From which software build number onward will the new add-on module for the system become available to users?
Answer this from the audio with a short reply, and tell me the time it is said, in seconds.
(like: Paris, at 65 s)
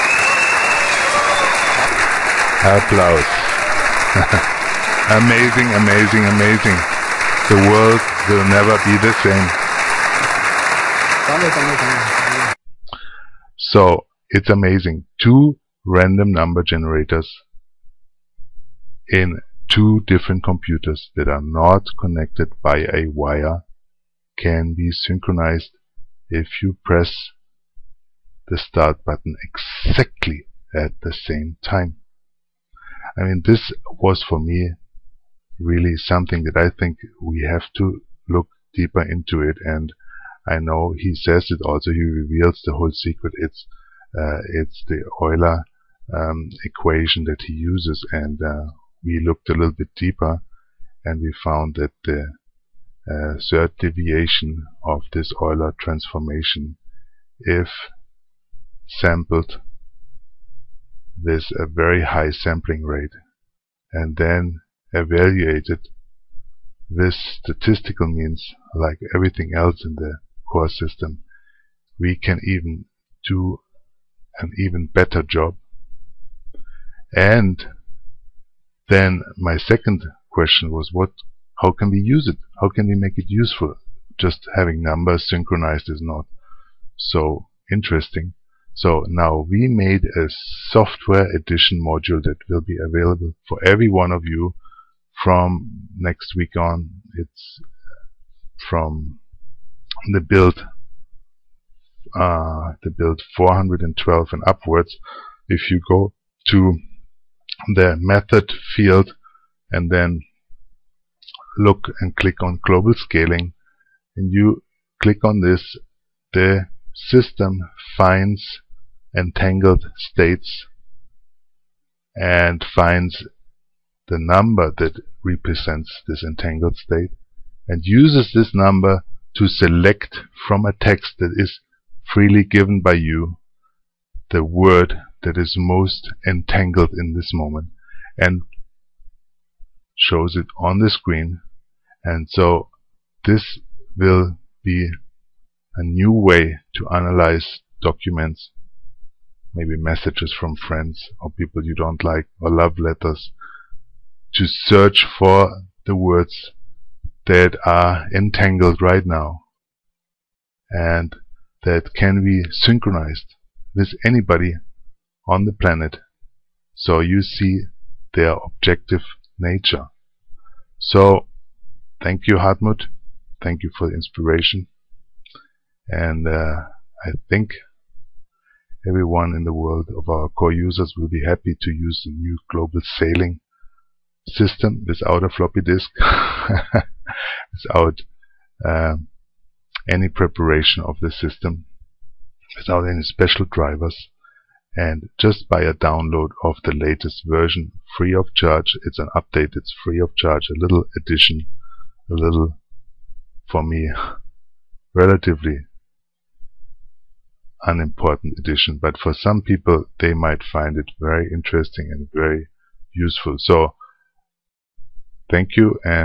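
412, at 103 s.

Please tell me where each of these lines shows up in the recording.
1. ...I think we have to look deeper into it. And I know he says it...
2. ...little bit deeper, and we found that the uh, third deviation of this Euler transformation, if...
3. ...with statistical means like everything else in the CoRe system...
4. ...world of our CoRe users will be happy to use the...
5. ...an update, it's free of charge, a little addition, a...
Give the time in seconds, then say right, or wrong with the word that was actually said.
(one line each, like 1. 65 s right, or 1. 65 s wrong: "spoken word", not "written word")
1. 36 s right
2. 49 s right
3. 66 s right
4. 179 s right
5. 198 s right.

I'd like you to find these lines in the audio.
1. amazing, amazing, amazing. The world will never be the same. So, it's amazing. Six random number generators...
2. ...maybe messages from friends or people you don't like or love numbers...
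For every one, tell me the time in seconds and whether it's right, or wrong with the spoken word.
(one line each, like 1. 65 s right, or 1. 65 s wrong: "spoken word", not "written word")
1. 5 s wrong: "Two", not "Six"
2. 149 s wrong: "letters", not "numbers".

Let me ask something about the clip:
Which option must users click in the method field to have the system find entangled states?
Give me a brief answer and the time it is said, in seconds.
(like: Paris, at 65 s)
global scaling, at 112 s.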